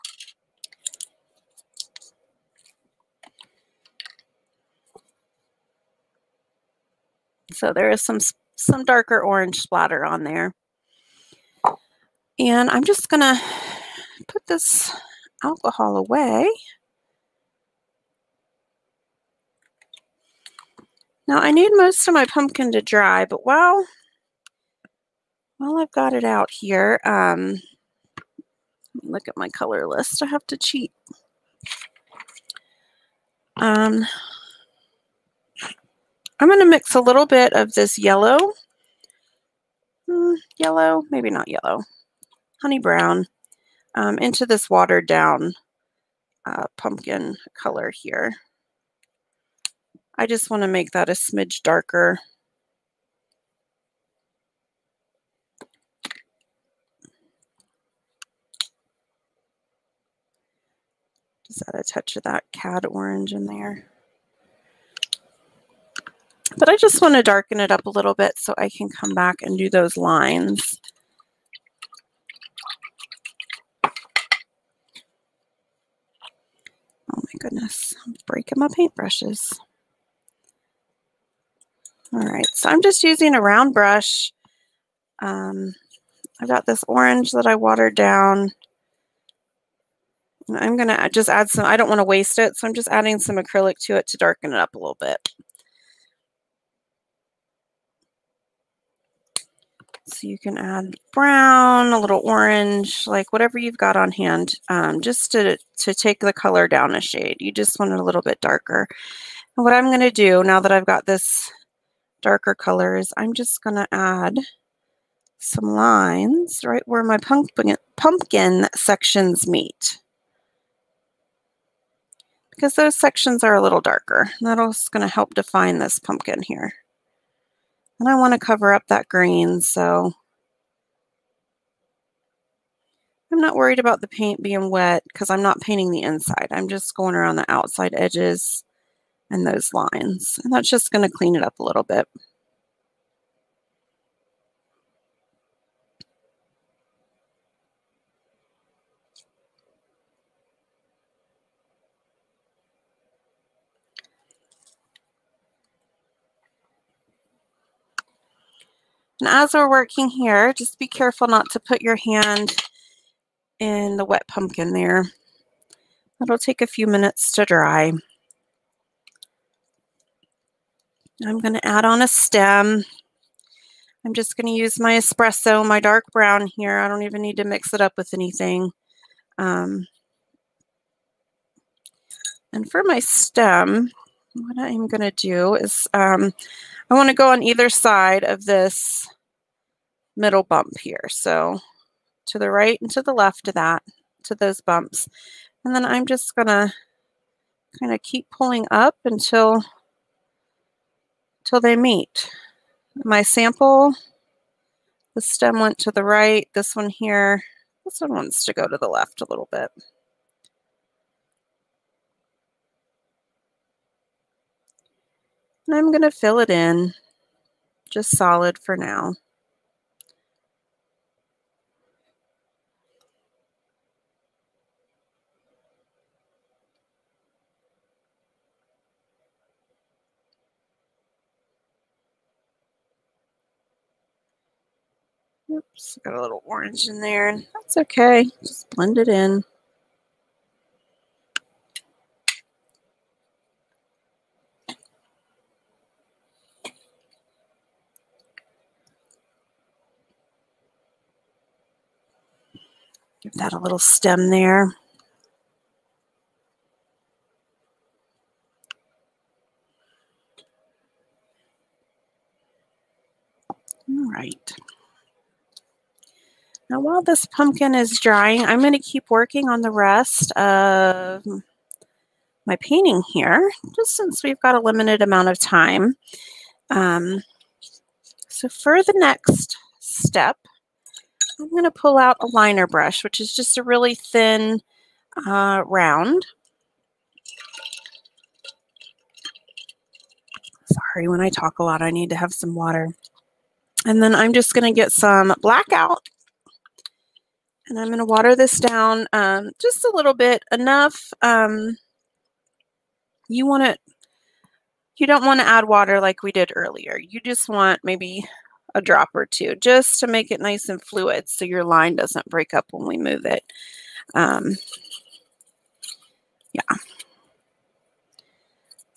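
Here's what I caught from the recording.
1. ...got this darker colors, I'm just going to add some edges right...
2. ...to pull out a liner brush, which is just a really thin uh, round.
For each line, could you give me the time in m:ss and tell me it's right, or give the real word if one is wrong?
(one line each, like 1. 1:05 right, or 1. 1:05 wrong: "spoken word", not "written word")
1. 1:50 wrong: "lines", not "edges"
2. 4:41 right.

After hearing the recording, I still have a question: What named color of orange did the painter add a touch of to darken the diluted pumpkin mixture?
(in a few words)
Cad orange.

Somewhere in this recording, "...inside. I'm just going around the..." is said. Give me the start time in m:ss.
2:16.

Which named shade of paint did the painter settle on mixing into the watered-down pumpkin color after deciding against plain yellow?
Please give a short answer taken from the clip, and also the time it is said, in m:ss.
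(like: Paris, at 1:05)
Honey brown, at 0:42.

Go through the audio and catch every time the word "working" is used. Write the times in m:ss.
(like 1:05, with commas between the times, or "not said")
2:39, 4:29.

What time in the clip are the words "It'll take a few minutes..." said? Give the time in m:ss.
2:46.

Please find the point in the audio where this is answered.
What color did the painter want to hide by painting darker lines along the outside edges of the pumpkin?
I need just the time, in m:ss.
2:09.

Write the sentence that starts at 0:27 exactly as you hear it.
Um, look at my color list.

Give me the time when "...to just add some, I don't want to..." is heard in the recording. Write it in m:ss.
1:30.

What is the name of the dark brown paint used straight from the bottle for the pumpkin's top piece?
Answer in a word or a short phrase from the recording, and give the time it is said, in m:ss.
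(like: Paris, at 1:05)
Espresso, at 2:54.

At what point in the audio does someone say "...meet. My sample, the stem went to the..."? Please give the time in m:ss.
3:21.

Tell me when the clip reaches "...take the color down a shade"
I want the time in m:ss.
1:45.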